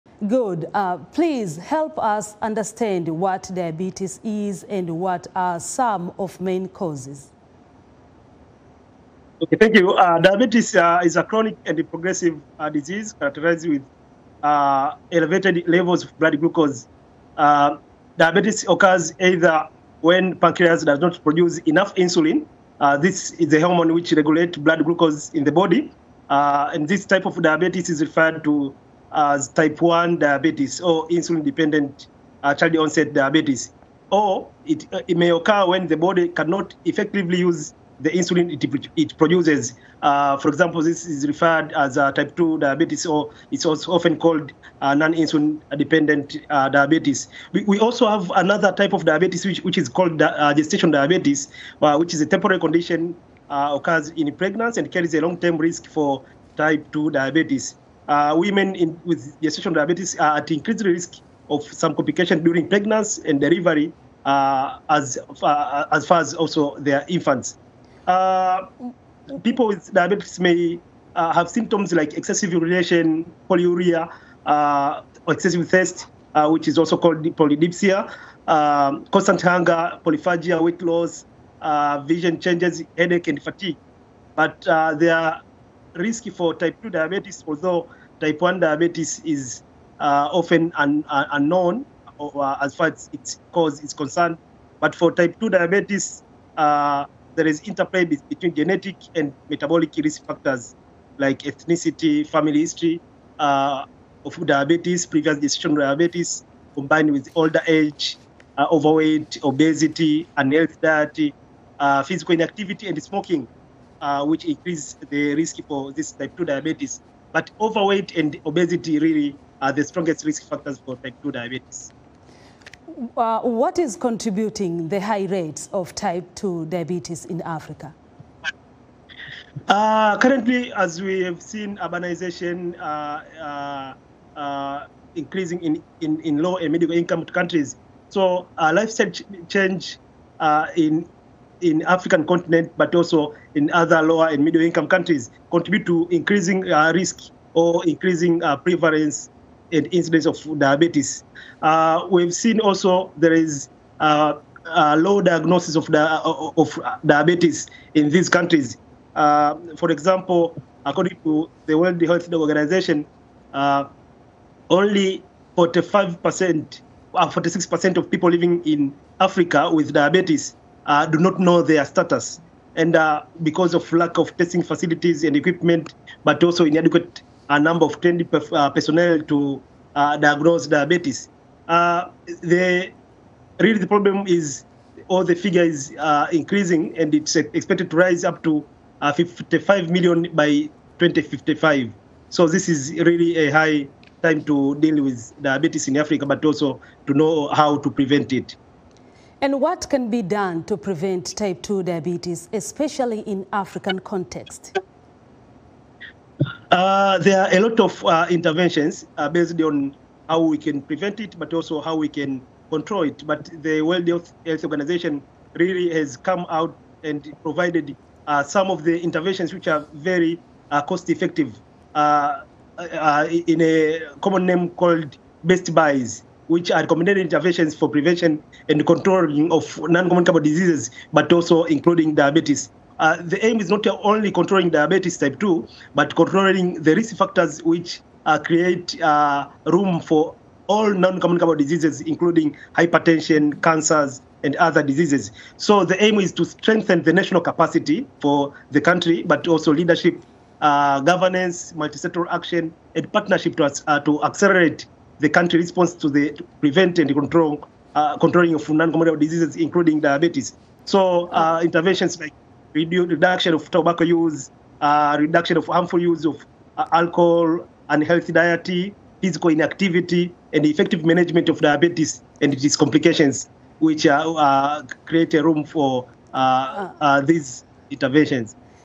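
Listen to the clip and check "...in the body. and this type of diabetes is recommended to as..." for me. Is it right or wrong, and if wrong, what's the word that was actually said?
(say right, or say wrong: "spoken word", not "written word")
wrong: "referred", not "recommended".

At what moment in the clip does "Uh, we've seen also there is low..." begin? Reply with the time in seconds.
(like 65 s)
151 s.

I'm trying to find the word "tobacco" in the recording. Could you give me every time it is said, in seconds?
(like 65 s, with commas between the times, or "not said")
263 s.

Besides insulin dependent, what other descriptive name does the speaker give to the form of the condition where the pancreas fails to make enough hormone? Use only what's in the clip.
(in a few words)
child onset diabetes.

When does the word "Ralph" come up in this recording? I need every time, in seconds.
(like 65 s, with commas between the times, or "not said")
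not said.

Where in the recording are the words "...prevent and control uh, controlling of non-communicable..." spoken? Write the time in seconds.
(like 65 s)
256 s.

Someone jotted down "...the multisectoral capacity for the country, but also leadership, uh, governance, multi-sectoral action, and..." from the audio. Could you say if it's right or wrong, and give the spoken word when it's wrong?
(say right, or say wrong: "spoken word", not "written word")
wrong: "national", not "multisectoral".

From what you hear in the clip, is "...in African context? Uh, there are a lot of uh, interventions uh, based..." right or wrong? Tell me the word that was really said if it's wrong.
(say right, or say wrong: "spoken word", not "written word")
right.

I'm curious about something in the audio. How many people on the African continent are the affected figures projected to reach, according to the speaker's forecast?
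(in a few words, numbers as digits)
55 million.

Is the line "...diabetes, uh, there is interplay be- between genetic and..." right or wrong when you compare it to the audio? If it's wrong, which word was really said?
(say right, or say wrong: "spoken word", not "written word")
right.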